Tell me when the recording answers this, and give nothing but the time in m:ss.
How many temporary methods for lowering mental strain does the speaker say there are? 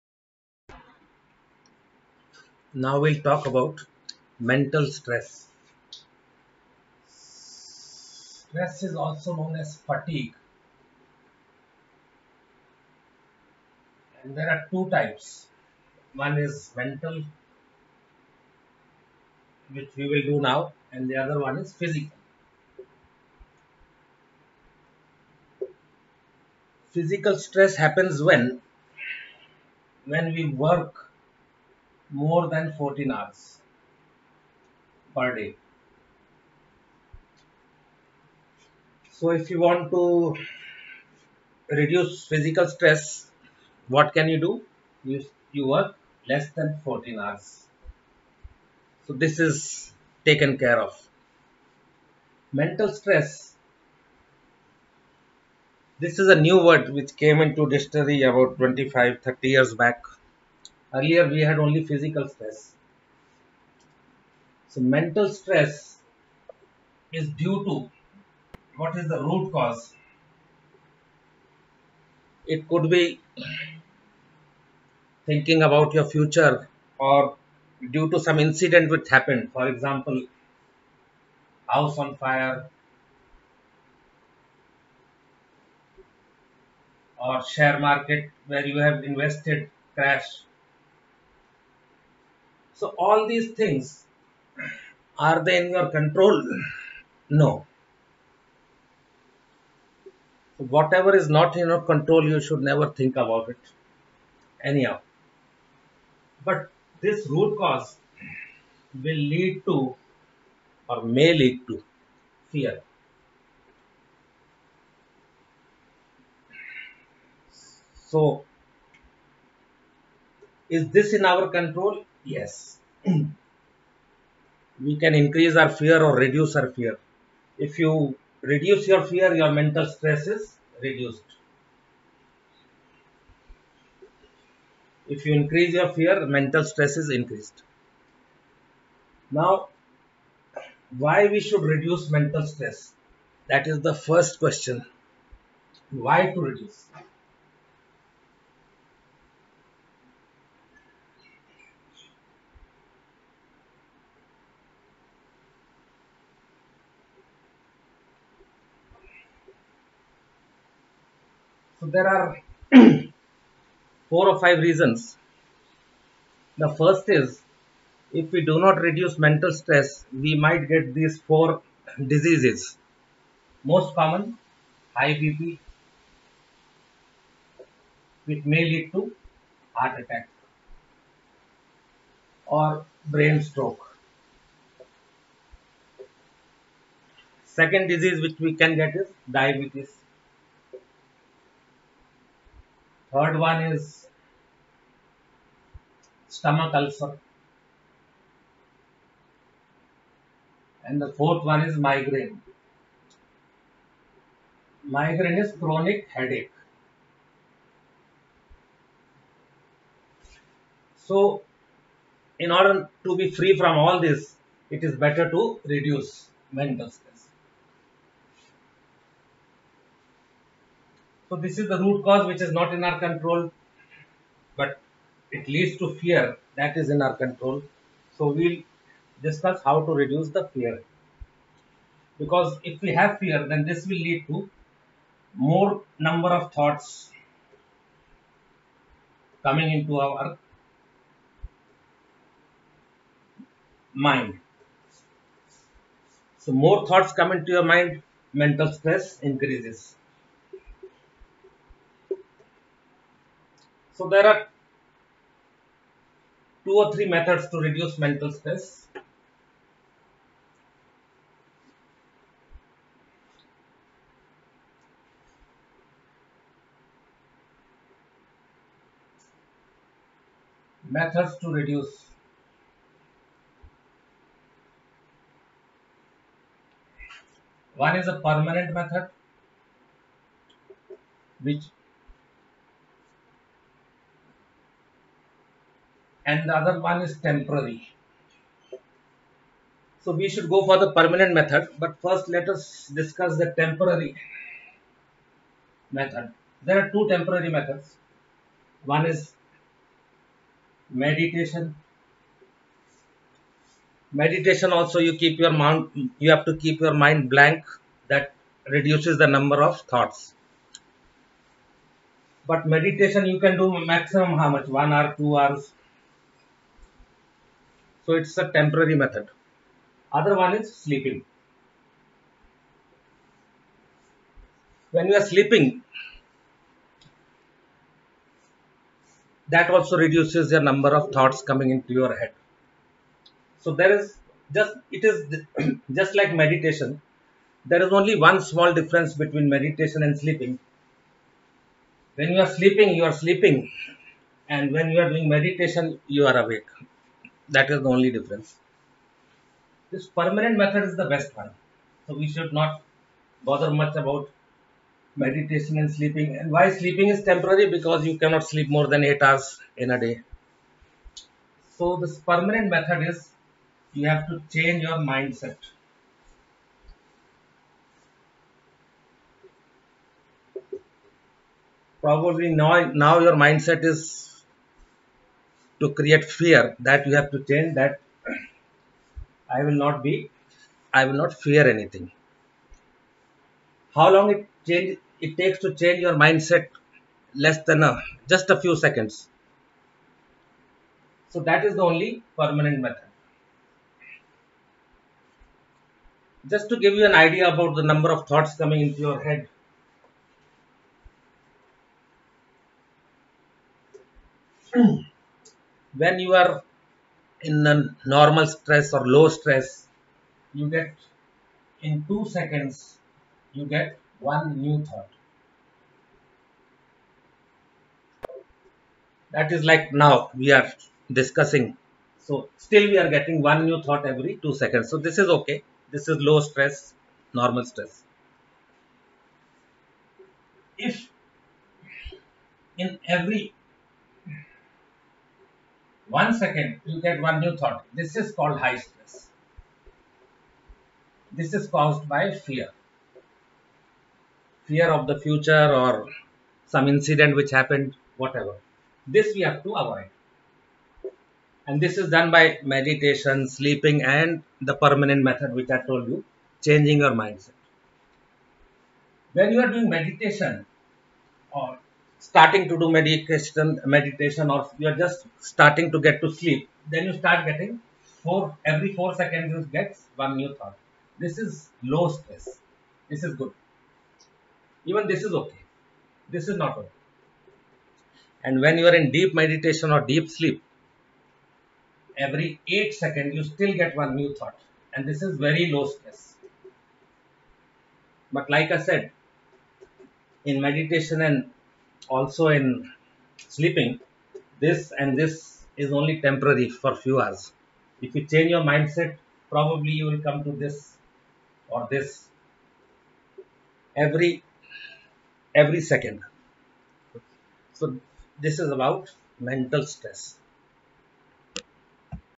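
4:56.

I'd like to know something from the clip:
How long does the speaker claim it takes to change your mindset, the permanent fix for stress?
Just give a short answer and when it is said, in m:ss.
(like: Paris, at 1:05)
A few seconds, at 6:28.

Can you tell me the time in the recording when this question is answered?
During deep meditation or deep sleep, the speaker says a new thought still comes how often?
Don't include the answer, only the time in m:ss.
8:02.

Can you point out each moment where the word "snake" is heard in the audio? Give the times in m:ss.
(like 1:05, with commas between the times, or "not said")
not said.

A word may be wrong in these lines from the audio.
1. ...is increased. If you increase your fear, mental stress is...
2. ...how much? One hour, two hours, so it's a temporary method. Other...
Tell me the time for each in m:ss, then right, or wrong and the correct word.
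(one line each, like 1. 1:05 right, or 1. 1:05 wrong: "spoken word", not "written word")
1. 2:10 wrong: "reduced", not "increased"
2. 5:14 right.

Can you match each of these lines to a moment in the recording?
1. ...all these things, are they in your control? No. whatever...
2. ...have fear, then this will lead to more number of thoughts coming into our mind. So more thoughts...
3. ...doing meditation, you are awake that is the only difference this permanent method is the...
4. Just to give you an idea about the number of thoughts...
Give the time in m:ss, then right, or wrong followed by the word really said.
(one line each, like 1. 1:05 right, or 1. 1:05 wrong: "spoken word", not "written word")
1. 1:32 right
2. 3:52 right
3. 5:45 right
4. 6:36 right.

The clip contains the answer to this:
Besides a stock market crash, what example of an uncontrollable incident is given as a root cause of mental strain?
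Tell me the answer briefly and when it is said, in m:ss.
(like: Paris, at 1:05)
House on fire, at 1:21.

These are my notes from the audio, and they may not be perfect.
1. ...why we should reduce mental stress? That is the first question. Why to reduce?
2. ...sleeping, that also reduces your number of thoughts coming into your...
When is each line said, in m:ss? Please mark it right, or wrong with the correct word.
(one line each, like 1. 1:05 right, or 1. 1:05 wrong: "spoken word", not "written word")
1. 2:20 right
2. 5:25 right.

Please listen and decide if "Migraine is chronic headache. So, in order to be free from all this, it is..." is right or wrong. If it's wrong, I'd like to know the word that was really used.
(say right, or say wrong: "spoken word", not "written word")
right.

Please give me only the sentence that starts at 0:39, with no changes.
So if you want to reduce physical stress, what can you do?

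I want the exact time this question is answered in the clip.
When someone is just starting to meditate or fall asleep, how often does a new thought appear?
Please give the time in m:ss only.
7:48.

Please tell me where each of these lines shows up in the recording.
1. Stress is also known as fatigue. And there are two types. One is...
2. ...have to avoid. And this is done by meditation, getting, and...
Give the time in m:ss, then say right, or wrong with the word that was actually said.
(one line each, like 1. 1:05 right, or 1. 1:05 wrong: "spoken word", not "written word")
1. 0:07 right
2. 7:29 wrong: "sleeping", not "getting".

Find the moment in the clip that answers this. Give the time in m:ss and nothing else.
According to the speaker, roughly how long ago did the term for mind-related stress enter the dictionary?
0:58.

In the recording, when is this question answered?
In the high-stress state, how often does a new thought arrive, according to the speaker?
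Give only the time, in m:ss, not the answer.
7:13.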